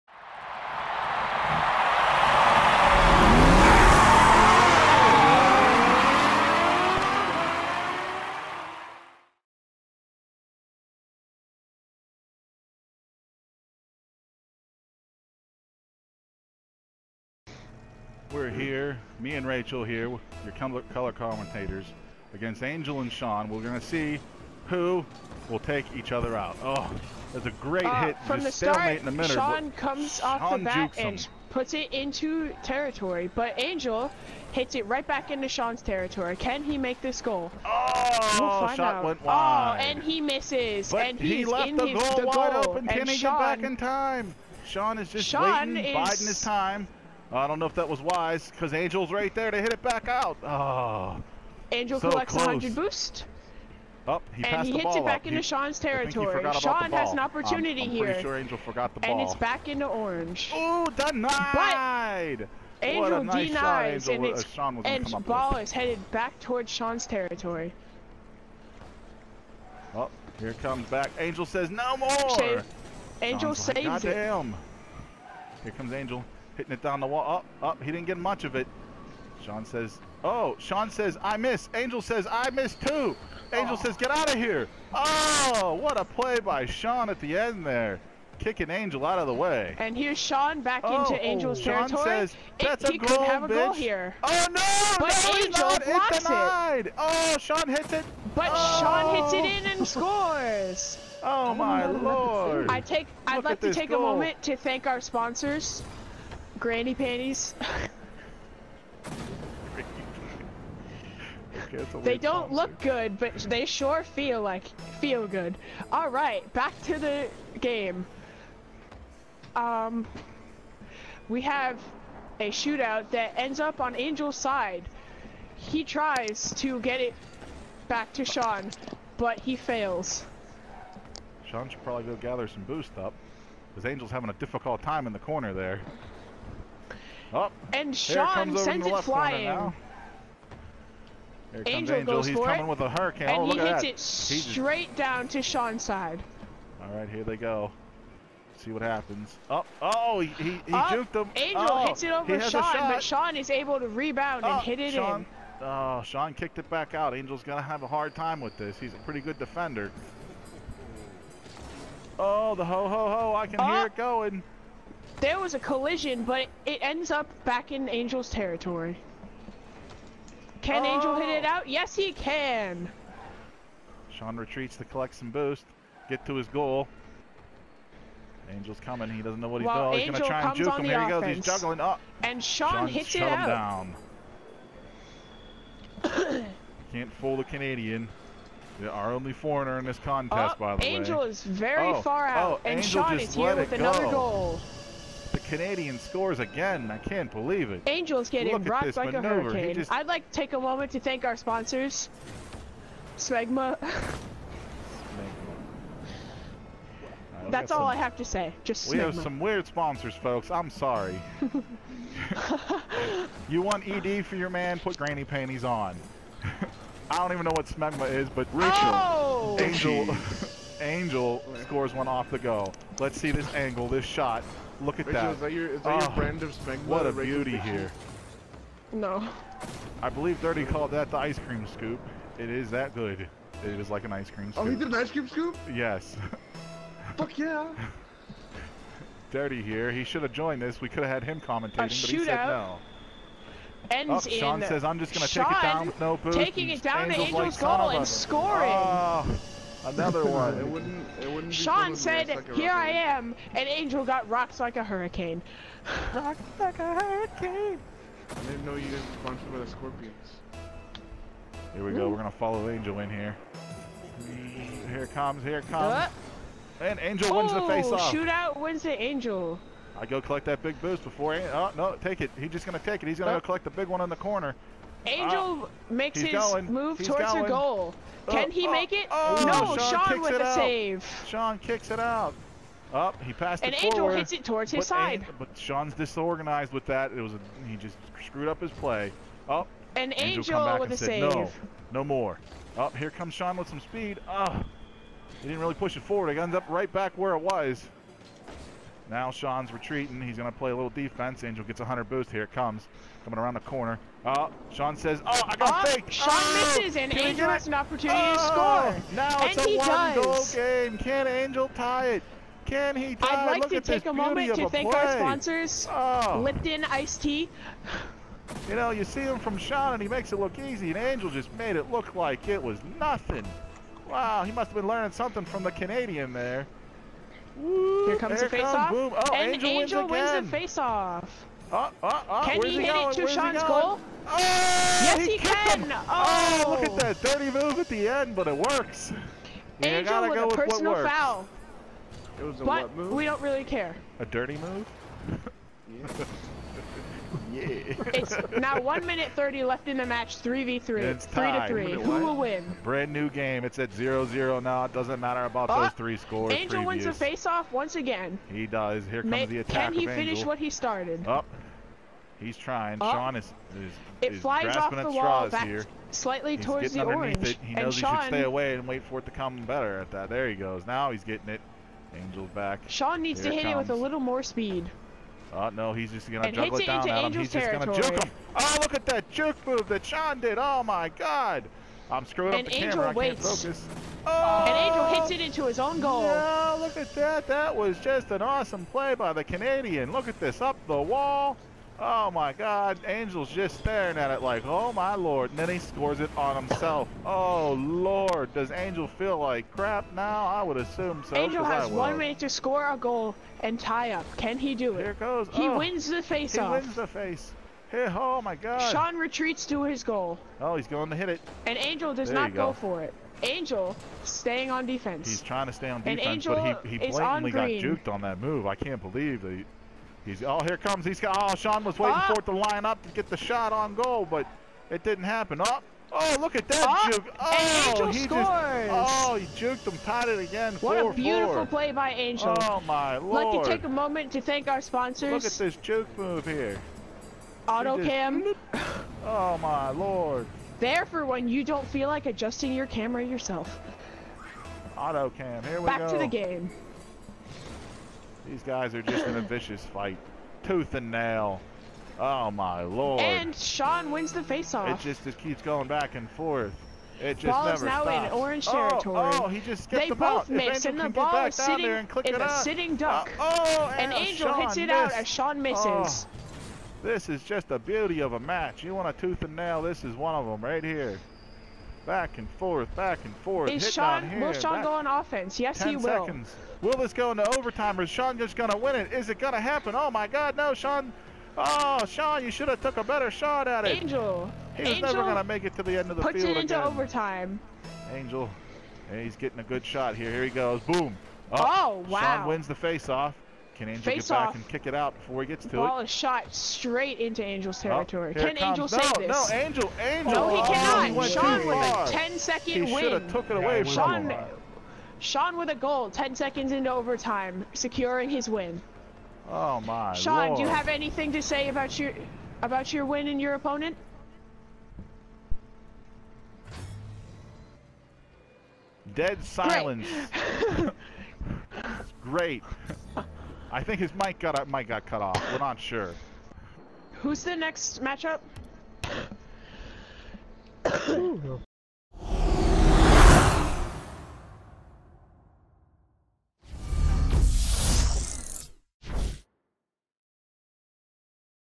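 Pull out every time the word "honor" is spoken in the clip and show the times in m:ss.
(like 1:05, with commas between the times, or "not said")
not said.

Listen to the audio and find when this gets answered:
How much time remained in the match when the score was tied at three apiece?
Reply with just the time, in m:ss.
5:48.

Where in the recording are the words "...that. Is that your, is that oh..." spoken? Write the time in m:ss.
3:45.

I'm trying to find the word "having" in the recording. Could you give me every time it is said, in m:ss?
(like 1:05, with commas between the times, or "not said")
2:14.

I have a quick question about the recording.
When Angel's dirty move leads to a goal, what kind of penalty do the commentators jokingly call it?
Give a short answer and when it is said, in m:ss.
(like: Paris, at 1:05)
personal foul, at 5:40.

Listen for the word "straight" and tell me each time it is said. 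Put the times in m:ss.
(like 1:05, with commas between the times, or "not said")
2:23, 8:16.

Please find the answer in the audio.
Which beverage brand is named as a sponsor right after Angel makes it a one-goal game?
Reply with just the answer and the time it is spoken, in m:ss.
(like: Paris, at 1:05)
Lipton Iced Tea, at 5:16.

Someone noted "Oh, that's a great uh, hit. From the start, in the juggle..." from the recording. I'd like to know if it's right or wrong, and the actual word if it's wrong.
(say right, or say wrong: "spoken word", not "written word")
wrong: "middle", not "juggle".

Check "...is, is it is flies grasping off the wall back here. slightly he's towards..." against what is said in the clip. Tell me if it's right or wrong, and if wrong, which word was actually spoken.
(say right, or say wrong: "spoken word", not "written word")
right.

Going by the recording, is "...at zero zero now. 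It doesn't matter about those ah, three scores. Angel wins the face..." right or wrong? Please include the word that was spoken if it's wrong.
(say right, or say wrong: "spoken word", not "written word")
right.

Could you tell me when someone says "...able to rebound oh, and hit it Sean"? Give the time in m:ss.
2:33.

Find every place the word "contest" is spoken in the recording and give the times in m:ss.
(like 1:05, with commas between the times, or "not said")
3:09.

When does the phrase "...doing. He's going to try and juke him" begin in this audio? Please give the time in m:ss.
2:59.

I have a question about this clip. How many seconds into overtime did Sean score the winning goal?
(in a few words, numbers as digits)
10.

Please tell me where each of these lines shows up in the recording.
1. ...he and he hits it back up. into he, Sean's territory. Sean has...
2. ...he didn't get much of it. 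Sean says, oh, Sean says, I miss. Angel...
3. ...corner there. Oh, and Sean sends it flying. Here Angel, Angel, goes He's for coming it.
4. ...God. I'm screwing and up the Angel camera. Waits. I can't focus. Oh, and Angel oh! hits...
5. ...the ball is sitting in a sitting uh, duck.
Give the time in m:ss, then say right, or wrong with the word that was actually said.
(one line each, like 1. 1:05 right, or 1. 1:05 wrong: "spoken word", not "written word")
1. 0:54 right
2. 1:17 right
3. 2:15 right
4. 6:21 right
5. 7:40 right.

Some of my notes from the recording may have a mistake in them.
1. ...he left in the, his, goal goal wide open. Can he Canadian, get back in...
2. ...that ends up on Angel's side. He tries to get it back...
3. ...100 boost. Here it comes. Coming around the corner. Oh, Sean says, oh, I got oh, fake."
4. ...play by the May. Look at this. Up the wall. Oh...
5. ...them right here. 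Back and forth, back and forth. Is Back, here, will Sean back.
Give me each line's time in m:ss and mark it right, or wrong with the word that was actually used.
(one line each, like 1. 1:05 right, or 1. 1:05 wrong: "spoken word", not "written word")
1. 0:41 wrong: "Sean", not "Canadian"
2. 2:03 right
3. 5:01 right
4. 6:28 wrong: "Canadian", not "May"
5. 7:50 wrong: "Sean", not "Back".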